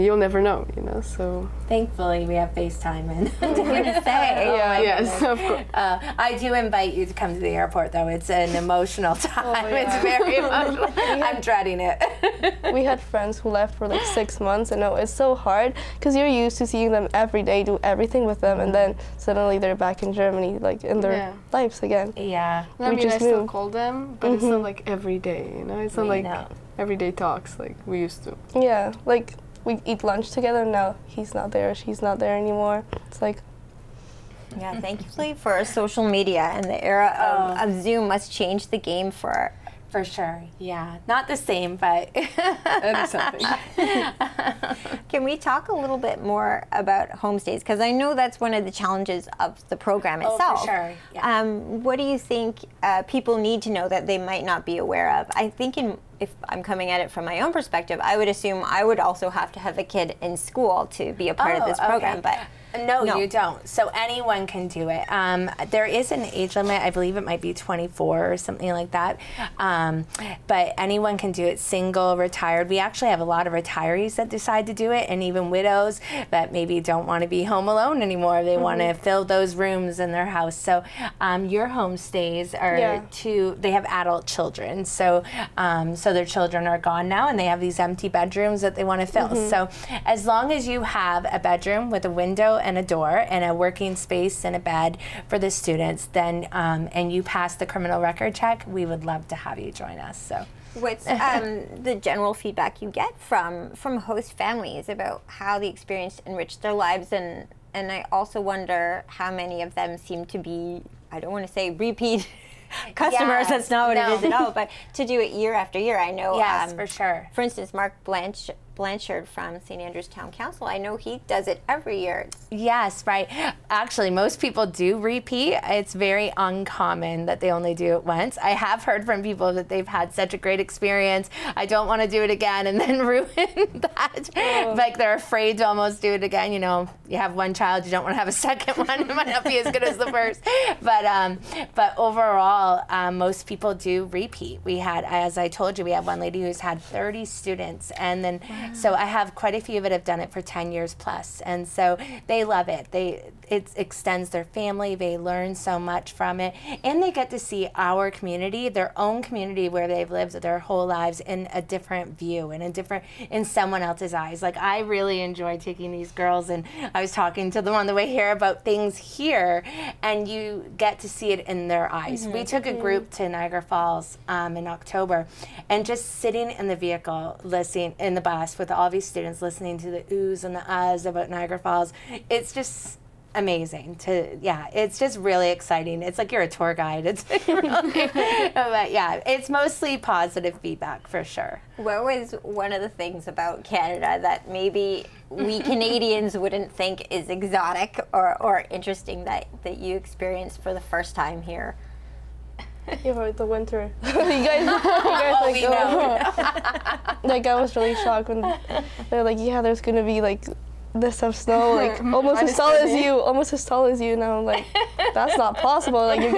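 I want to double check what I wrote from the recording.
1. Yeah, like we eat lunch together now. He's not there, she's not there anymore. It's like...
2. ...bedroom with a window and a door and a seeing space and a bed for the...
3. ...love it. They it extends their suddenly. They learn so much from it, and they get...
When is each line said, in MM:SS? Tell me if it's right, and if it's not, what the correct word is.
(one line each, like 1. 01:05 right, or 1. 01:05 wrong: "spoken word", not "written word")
1. 00:28 right
2. 01:31 wrong: "working", not "seeing"
3. 02:32 wrong: "family", not "suddenly".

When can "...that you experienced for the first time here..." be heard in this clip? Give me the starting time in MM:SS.
03:19.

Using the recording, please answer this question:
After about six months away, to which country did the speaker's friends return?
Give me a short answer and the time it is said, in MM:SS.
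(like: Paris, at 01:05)
Germany, at 00:20.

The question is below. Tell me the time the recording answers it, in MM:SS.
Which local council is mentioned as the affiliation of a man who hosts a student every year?
01:59.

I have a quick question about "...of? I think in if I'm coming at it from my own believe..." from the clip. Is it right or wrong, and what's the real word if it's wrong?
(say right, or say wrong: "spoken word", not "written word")
wrong: "perspective", not "believe".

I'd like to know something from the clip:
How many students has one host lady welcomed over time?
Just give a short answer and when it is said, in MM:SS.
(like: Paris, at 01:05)
30, at 02:26.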